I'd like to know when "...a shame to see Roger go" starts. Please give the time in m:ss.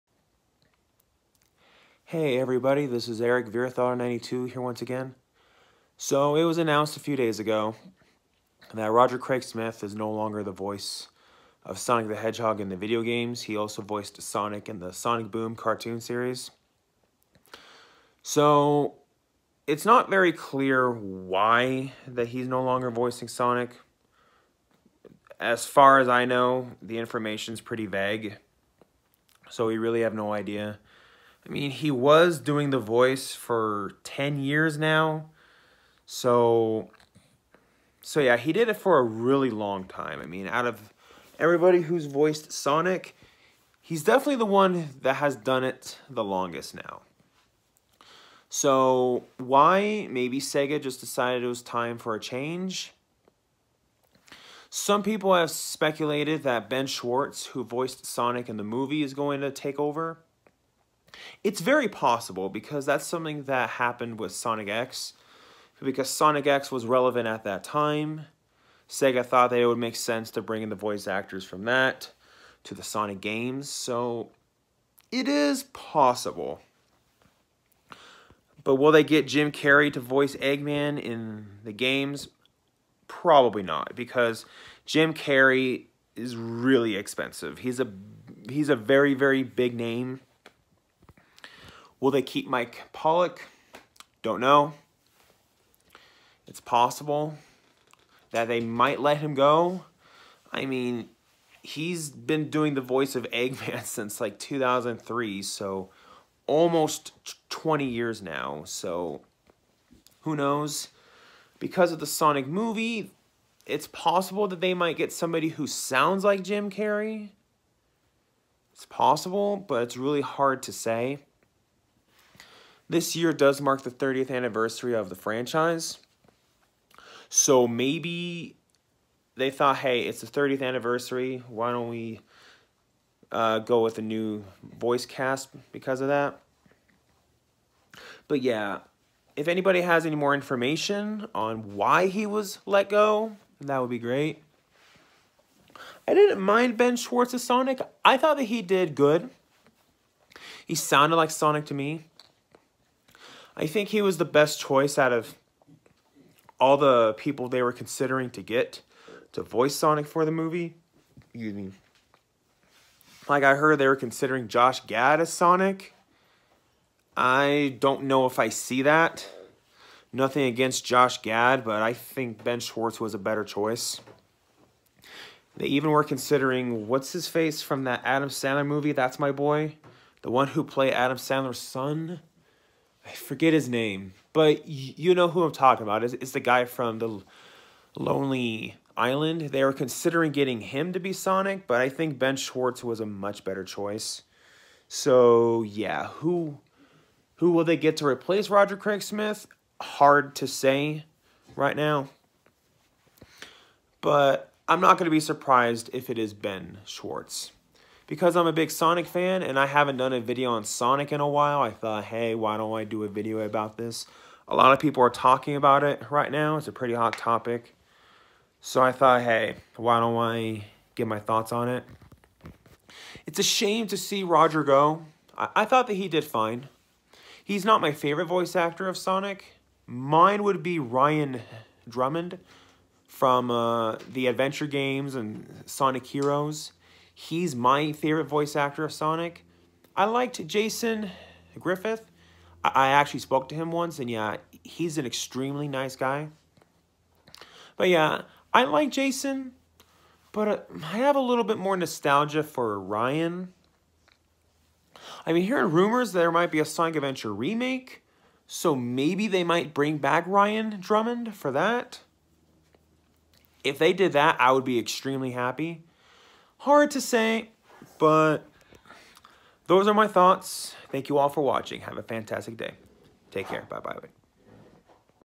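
3:43.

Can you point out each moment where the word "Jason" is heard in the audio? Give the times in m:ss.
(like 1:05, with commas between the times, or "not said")
4:00, 4:08.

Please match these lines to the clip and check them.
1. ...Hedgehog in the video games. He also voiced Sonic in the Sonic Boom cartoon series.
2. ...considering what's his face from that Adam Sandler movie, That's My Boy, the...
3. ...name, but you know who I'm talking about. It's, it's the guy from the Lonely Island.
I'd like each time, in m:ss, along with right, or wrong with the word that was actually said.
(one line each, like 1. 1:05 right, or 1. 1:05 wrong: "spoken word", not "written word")
1. 0:12 right
2. 2:56 right
3. 3:03 right.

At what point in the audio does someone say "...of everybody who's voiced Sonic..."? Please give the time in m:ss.
0:40.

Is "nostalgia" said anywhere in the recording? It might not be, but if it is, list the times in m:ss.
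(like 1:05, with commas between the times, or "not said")
4:11.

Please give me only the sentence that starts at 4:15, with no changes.
I mean, hearing rumors there might be a Sonic Adventure remake, so maybe they might bring back Ryan Drummond for that.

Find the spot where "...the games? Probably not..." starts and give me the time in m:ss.
1:21.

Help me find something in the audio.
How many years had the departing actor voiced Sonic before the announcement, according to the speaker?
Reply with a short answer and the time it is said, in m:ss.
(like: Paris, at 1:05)
10 years, at 0:34.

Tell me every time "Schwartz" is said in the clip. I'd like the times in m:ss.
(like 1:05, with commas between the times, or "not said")
0:56, 2:26, 2:52, 3:12, 3:26.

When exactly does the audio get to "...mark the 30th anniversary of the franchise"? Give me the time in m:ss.
2:03.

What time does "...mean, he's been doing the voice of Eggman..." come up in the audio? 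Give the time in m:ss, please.
1:40.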